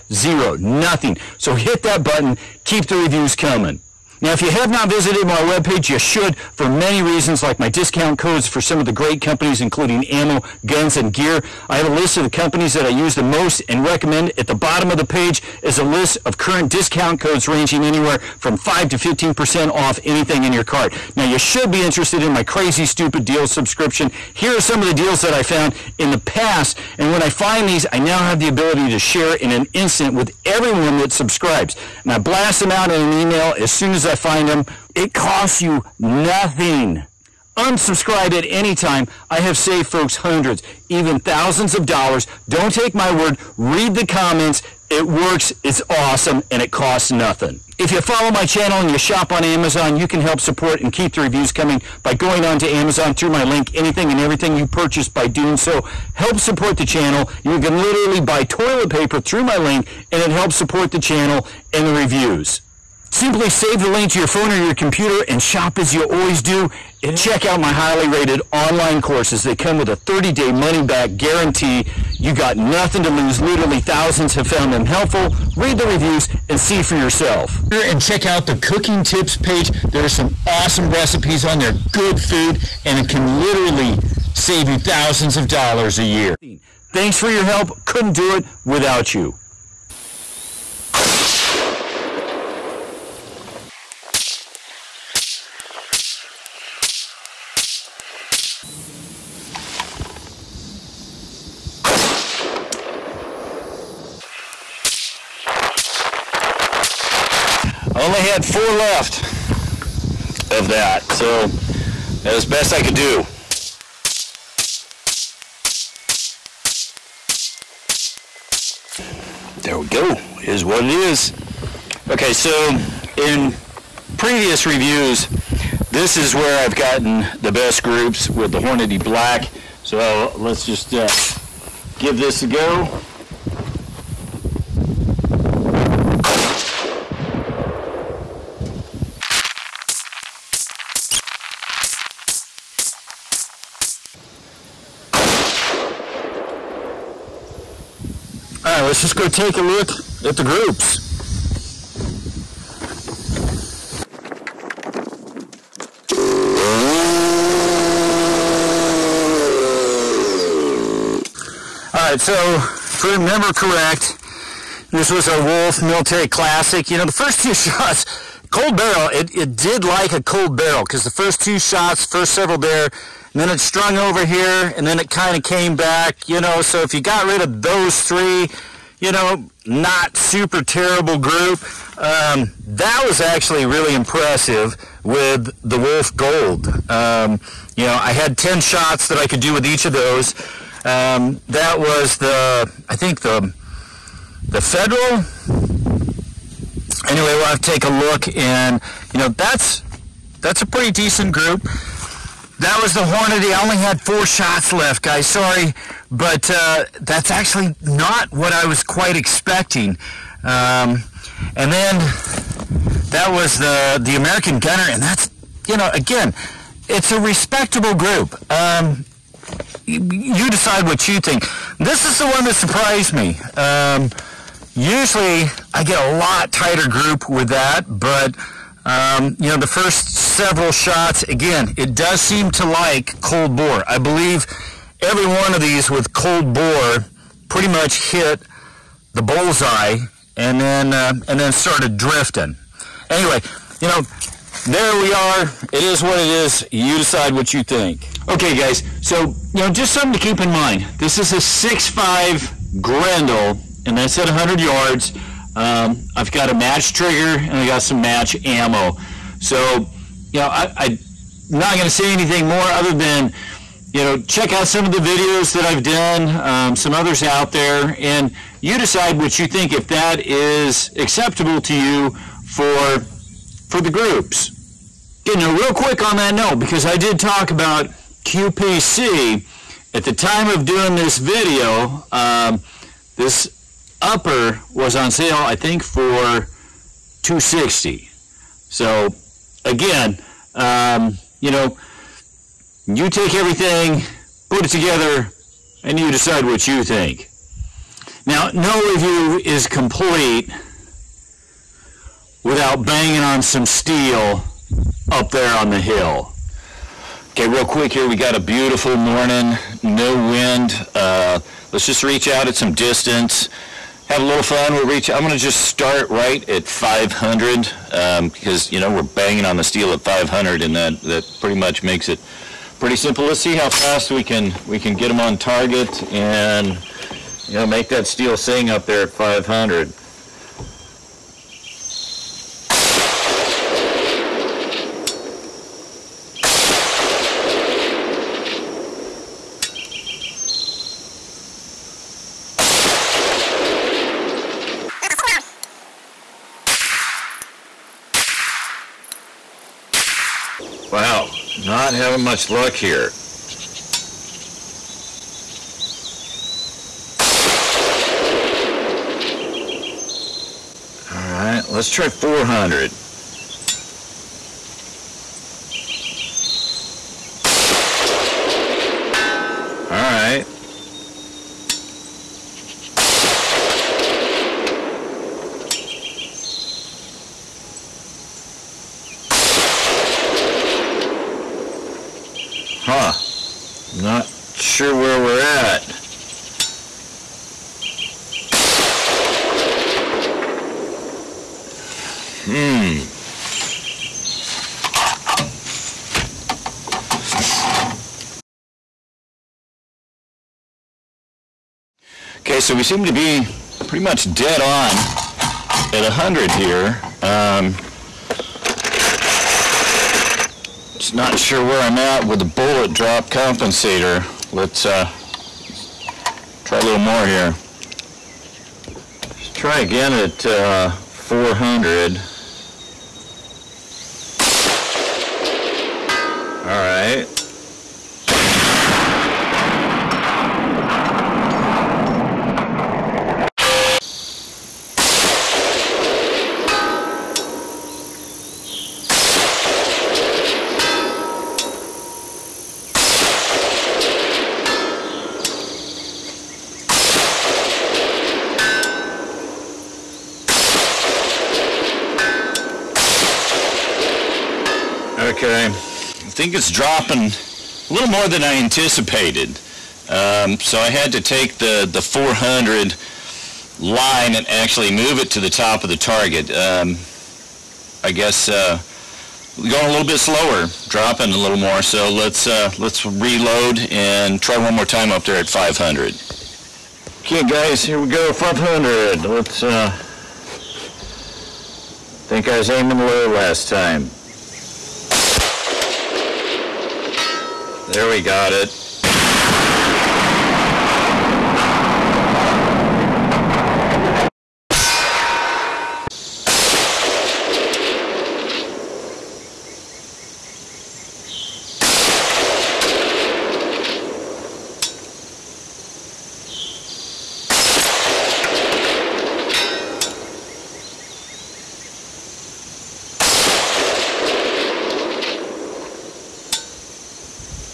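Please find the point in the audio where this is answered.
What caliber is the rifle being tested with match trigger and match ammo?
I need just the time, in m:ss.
4:11.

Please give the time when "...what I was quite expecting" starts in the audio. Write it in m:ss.
3:28.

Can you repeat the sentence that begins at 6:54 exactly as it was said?
Let's uh, try a little more here.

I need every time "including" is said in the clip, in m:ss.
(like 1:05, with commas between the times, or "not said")
0:09.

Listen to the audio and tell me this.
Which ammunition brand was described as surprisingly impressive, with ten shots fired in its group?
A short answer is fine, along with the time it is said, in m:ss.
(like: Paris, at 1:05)
Wolf Gold, at 3:05.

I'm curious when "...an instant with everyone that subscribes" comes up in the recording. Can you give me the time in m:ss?
0:29.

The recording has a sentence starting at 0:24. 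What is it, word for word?
Here are some of the deals that I found in the past.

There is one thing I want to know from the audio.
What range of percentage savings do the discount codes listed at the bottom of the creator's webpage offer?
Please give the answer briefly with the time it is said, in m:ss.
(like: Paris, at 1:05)
5 to 15%, at 0:18.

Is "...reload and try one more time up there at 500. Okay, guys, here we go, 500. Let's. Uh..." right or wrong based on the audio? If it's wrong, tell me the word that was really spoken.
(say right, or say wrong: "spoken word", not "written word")
right.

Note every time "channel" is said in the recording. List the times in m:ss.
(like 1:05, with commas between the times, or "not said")
0:48, 0:56, 1:00.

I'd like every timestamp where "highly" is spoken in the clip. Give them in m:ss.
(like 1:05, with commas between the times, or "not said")
1:07.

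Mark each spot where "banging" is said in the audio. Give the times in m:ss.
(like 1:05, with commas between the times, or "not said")
5:02, 5:19.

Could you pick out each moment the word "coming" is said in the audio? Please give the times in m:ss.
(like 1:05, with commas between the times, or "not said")
0:03, 0:51.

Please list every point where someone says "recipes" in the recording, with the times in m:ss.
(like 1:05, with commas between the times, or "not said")
1:20.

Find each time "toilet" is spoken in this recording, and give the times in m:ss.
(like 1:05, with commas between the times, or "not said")
0:58.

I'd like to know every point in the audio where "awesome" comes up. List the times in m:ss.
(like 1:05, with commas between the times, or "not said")
0:45, 1:20.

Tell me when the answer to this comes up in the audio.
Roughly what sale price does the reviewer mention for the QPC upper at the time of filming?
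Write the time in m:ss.
4:47.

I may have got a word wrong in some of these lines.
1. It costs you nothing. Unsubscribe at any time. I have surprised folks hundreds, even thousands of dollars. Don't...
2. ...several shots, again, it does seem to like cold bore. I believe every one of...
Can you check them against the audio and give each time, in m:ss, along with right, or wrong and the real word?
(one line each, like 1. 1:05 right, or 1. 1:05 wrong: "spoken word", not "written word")
1. 0:34 wrong: "saved", not "surprised"
2. 3:50 right.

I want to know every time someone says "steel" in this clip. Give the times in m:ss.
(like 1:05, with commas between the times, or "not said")
5:03, 5:19, 5:28.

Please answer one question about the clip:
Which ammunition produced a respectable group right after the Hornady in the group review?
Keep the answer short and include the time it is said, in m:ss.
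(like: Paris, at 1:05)
American Gunner, at 3:34.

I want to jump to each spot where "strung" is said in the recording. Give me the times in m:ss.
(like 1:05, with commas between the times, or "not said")
2:53.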